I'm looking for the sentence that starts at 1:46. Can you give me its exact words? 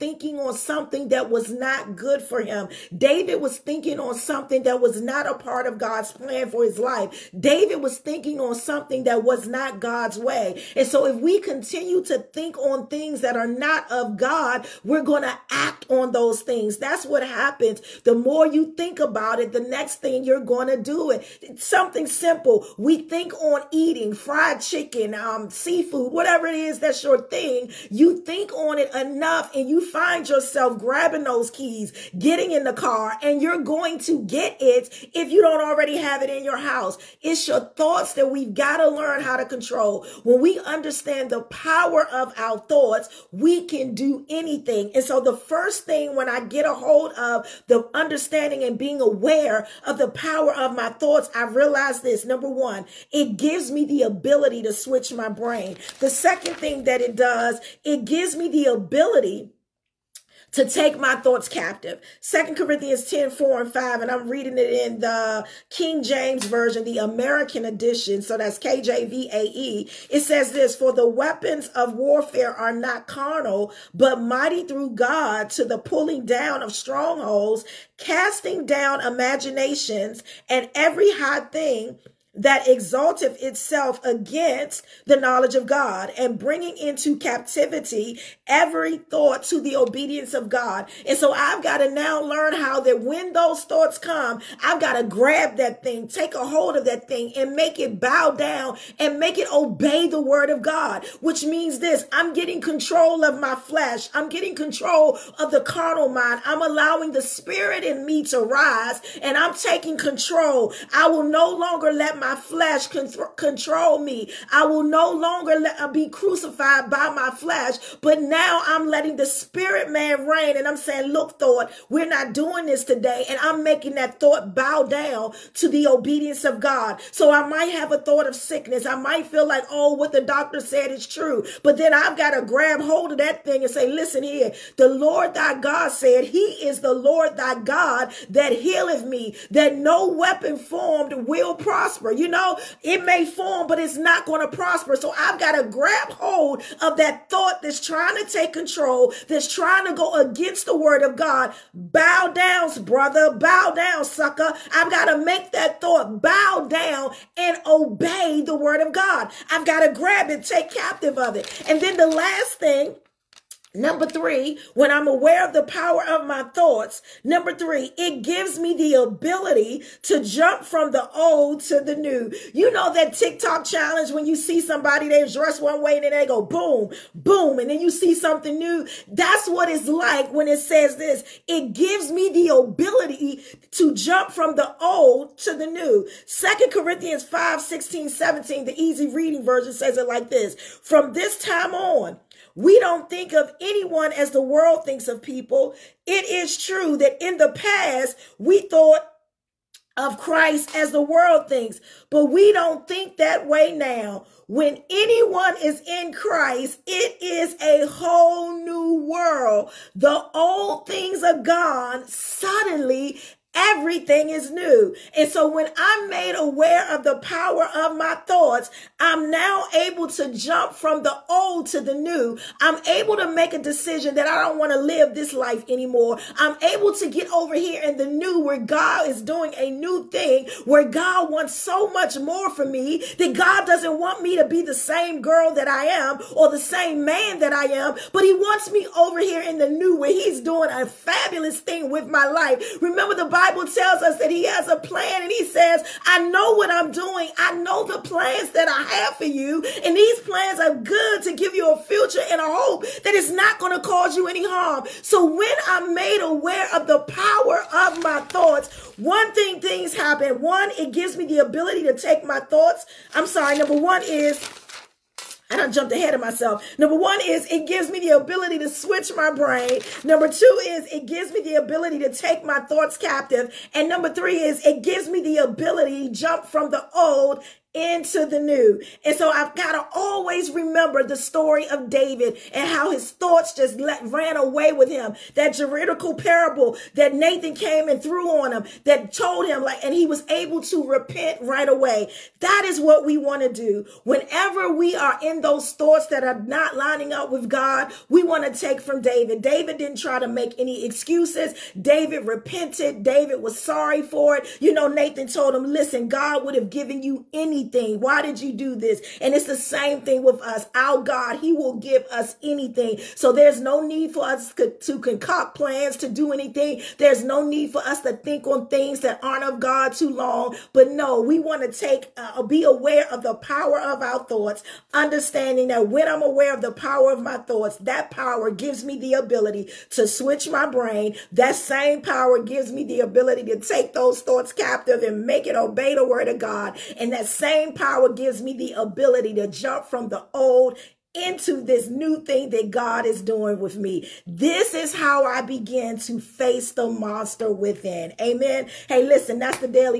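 I'm allowing the spirit in me to rise and I'm taking control.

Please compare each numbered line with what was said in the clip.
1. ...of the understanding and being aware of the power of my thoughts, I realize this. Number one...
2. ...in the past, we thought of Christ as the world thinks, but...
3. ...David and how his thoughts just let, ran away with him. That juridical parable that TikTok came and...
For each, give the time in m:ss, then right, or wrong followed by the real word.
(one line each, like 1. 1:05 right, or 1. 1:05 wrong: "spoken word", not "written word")
1. 0:47 right
2. 3:17 right
3. 4:41 wrong: "Nathan", not "TikTok".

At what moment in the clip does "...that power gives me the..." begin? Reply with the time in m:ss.
5:27.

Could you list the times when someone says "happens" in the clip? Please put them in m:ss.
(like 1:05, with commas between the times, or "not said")
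0:17, 4:19.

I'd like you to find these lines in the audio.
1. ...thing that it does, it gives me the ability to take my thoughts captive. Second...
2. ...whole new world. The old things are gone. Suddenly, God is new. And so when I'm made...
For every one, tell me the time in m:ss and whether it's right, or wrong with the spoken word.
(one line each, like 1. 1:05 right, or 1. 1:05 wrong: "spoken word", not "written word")
1. 0:56 right
2. 3:27 wrong: "Everything", not "God".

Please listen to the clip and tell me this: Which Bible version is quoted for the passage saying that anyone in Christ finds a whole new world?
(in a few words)
Easy Reading Version.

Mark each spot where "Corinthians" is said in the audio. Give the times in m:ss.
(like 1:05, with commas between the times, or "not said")
1:02, 3:06.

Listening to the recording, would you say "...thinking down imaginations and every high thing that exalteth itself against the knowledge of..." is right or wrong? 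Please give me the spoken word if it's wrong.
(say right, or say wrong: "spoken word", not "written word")
wrong: "casting", not "thinking".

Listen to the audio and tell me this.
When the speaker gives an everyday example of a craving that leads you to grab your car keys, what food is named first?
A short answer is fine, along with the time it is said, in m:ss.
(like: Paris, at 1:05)
fried chicken, at 0:24.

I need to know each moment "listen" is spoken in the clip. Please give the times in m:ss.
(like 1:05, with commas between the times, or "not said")
2:13, 5:05, 5:49.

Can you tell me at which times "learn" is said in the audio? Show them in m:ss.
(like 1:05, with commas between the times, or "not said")
0:38, 1:32.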